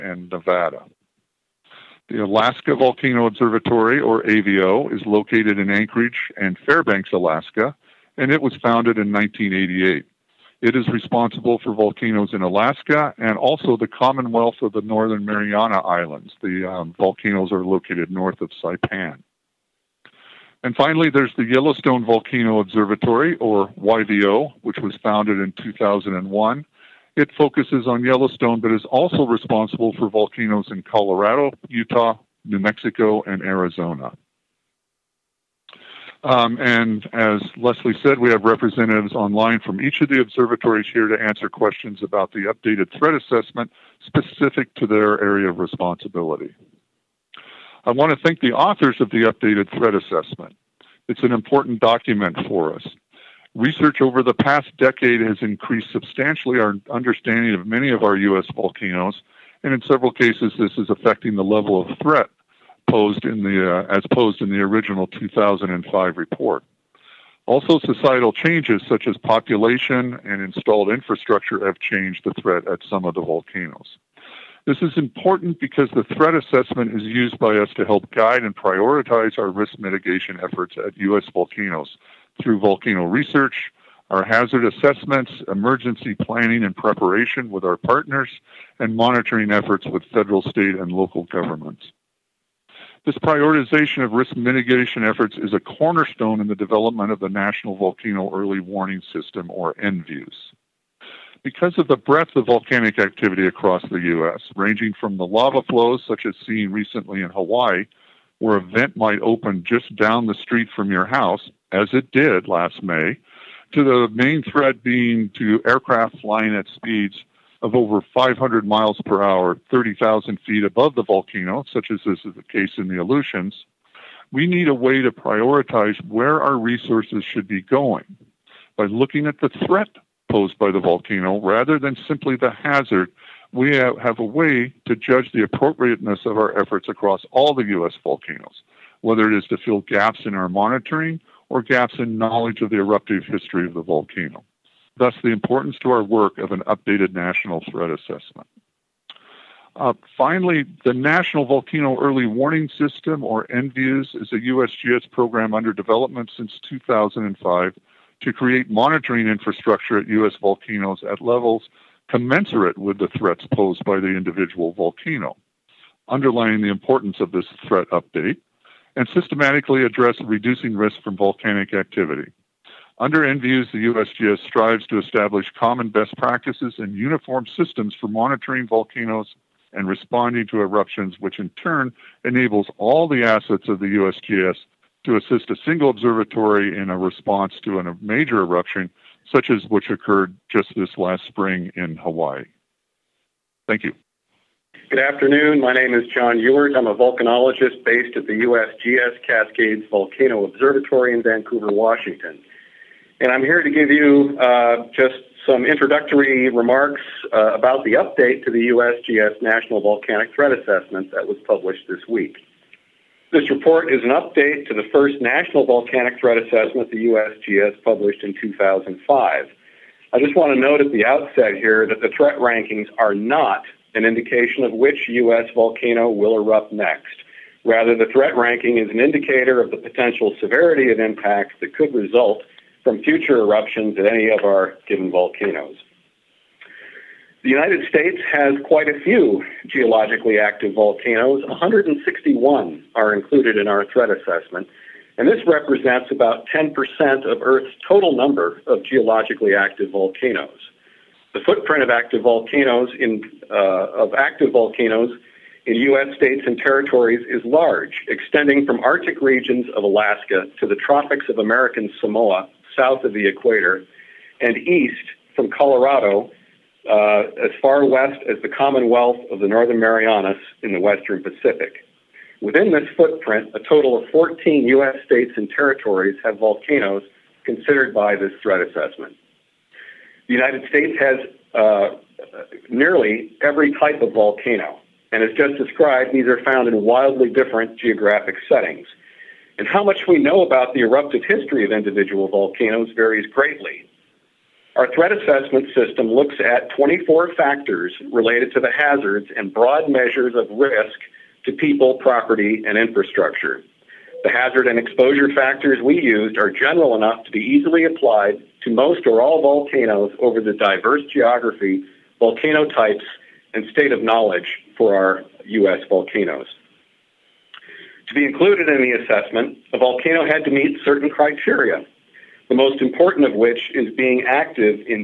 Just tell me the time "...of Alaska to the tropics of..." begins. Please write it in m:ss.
4:19.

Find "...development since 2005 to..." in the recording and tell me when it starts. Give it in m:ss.
2:35.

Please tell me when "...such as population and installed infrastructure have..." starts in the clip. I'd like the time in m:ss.
1:08.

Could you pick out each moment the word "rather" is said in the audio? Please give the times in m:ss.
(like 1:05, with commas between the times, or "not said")
2:11, 3:47.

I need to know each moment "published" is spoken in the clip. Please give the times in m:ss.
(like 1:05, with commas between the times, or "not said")
3:31, 3:37.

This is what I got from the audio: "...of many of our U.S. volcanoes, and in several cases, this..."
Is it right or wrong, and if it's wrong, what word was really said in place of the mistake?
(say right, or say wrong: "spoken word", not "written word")
right.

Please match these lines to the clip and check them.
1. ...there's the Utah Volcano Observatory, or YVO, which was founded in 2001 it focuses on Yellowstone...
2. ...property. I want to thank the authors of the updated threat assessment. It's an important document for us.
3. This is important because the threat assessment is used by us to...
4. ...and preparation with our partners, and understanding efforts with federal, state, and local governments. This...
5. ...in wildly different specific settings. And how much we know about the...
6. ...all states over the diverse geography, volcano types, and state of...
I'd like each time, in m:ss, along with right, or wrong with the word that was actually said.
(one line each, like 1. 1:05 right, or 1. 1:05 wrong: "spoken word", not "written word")
1. 0:21 wrong: "Yellowstone", not "Utah"
2. 0:45 wrong: "responsibility", not "property"
3. 1:14 right
4. 1:26 wrong: "monitoring", not "understanding"
5. 4:46 wrong: "geographic", not "specific"
6. 5:09 wrong: "volcanoes", not "states".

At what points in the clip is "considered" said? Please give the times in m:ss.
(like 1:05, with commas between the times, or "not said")
4:37.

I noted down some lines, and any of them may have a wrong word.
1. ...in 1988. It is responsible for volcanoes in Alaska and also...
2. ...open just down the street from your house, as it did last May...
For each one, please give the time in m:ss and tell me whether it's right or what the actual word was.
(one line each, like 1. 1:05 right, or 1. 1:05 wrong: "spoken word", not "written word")
1. 0:08 right
2. 1:49 right.